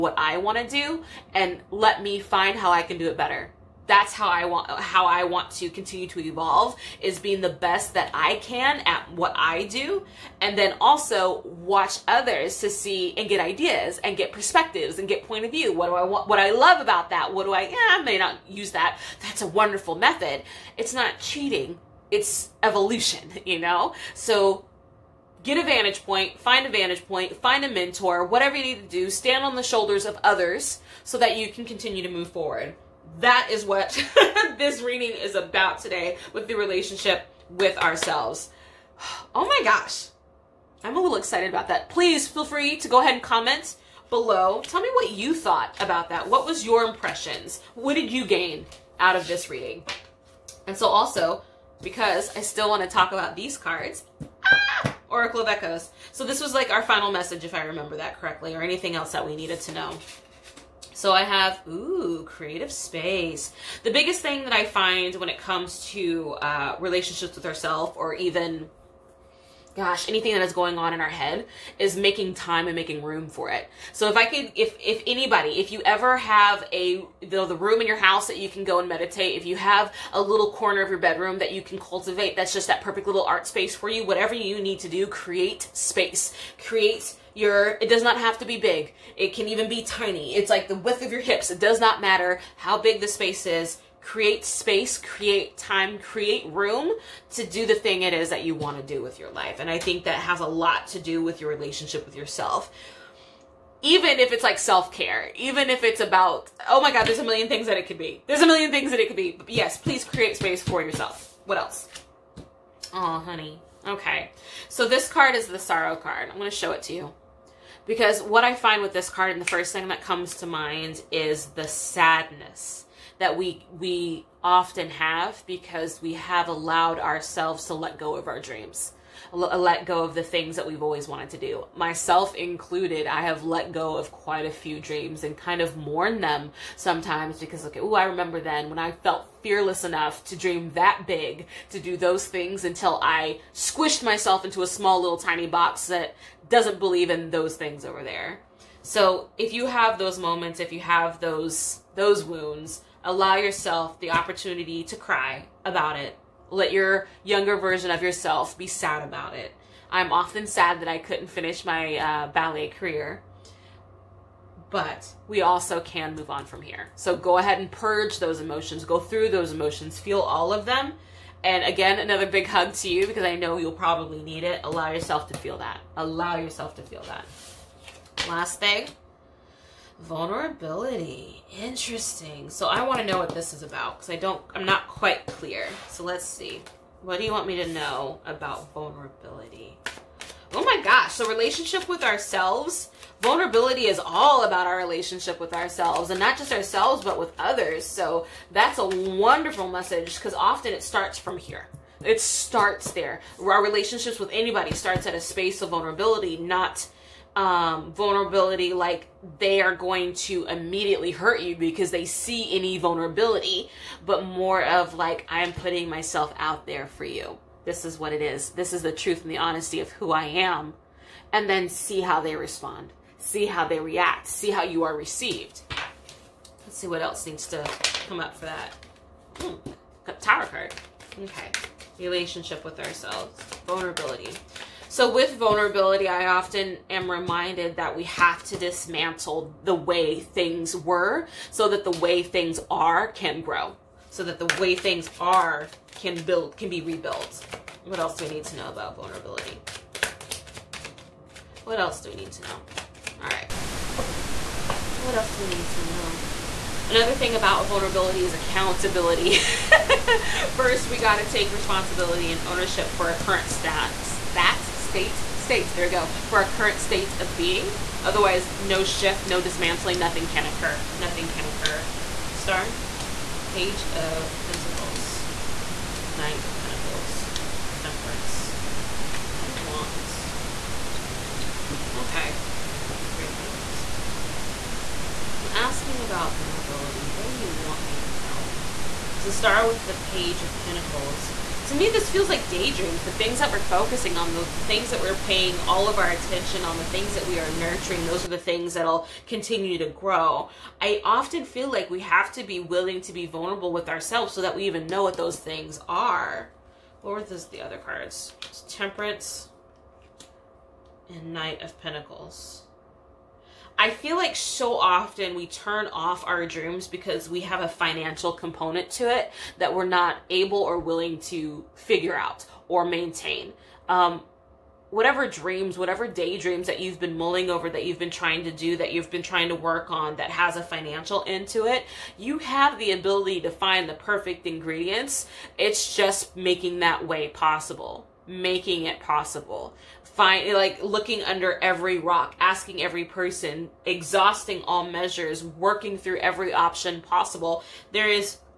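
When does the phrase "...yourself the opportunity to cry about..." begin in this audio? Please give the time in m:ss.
2:33.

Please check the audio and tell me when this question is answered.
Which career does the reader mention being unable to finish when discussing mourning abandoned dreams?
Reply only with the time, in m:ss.
2:42.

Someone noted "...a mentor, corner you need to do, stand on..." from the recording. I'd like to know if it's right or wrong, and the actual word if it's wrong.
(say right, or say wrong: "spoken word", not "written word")
wrong: "whatever", not "corner".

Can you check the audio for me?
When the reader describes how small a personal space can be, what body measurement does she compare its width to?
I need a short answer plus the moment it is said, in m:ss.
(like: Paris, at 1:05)
the width of your hips, at 1:30.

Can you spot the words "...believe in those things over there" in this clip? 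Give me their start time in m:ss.
2:26.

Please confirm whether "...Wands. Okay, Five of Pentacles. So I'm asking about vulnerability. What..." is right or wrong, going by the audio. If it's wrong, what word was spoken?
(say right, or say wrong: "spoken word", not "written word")
wrong: "Three", not "Five".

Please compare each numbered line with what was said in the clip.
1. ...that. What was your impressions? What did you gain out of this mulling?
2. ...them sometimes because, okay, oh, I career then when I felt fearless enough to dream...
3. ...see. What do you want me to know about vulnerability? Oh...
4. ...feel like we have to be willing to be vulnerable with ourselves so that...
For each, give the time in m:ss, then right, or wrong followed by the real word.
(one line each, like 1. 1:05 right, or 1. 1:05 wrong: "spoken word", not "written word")
1. 0:46 wrong: "reading", not "mulling"
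2. 2:16 wrong: "remember", not "career"
3. 3:06 right
4. 5:01 right.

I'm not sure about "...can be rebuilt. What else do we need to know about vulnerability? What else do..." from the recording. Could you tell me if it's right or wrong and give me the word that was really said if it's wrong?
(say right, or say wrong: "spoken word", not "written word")
right.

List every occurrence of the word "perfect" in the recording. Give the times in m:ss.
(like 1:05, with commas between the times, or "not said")
1:22, 5:33.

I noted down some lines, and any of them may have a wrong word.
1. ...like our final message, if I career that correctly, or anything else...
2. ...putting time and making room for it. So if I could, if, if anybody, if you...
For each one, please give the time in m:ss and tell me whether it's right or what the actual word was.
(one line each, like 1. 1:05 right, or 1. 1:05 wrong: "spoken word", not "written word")
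1. 0:56 wrong: "remember", not "career"
2. 1:11 wrong: "making", not "putting".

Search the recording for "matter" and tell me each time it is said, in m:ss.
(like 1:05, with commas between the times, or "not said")
1:31.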